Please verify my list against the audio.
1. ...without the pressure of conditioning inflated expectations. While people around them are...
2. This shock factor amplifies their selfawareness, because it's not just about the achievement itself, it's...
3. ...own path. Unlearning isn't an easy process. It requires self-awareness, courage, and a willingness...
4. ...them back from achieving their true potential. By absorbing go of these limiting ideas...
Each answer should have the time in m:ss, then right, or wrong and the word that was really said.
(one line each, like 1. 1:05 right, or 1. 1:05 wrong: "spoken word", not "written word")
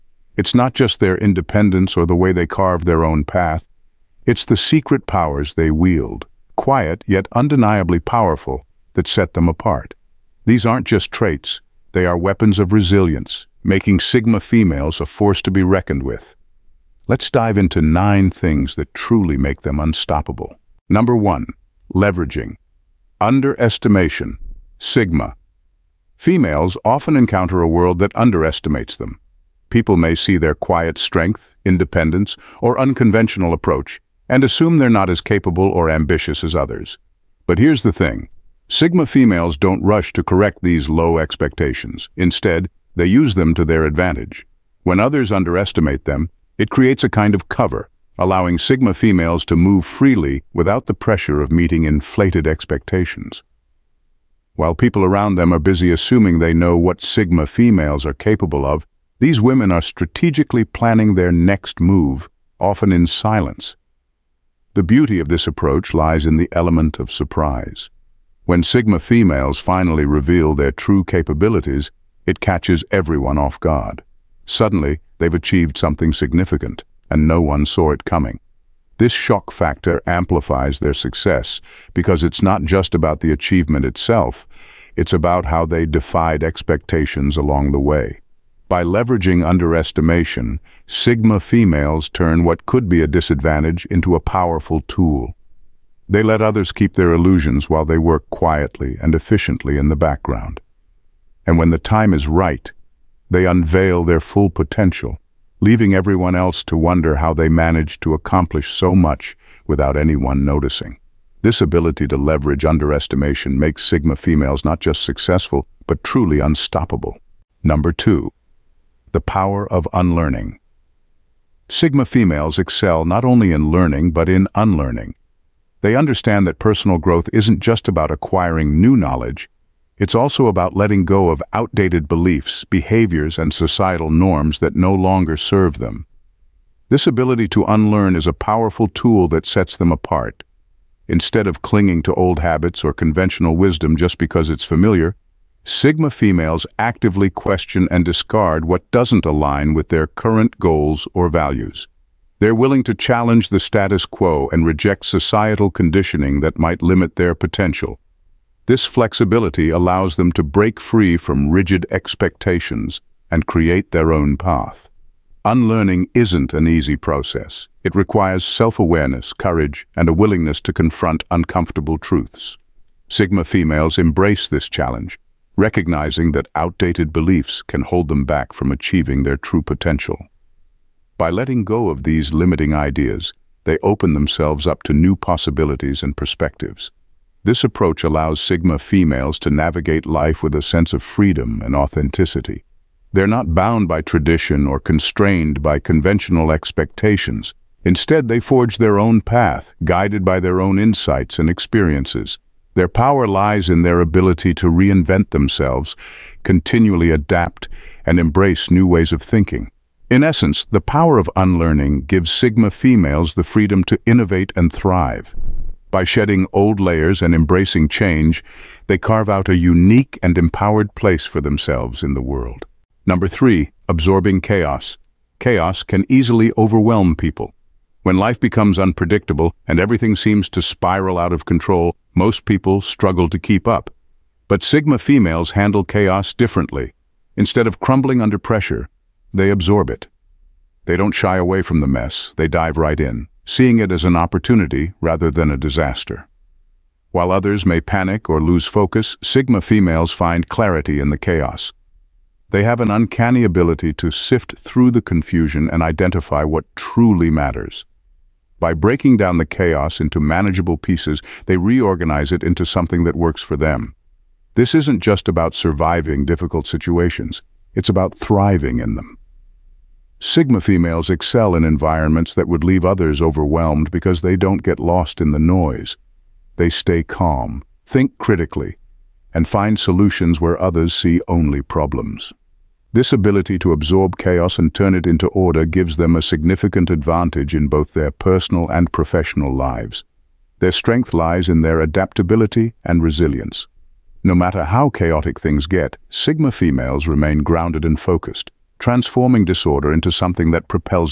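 1. 0:50 wrong: "meeting", not "conditioning"
2. 1:18 wrong: "success", not "selfawareness"
3. 2:44 right
4. 2:58 wrong: "letting", not "absorbing".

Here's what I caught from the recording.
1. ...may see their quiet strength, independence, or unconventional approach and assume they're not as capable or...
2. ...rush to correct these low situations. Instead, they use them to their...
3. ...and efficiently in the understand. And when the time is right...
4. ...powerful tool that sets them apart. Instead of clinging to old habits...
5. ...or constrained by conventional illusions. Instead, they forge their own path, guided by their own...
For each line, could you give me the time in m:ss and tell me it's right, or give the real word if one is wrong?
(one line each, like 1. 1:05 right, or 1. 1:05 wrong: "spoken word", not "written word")
1. 0:29 right
2. 0:39 wrong: "expectations", not "situations"
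3. 1:39 wrong: "background", not "understand"
4. 2:18 right
5. 3:14 wrong: "expectations", not "illusions".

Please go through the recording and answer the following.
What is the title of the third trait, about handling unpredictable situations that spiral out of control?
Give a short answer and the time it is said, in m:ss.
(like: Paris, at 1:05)
absorbing chaos, at 3:43.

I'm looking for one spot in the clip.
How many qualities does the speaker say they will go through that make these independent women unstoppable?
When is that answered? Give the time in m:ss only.
0:17.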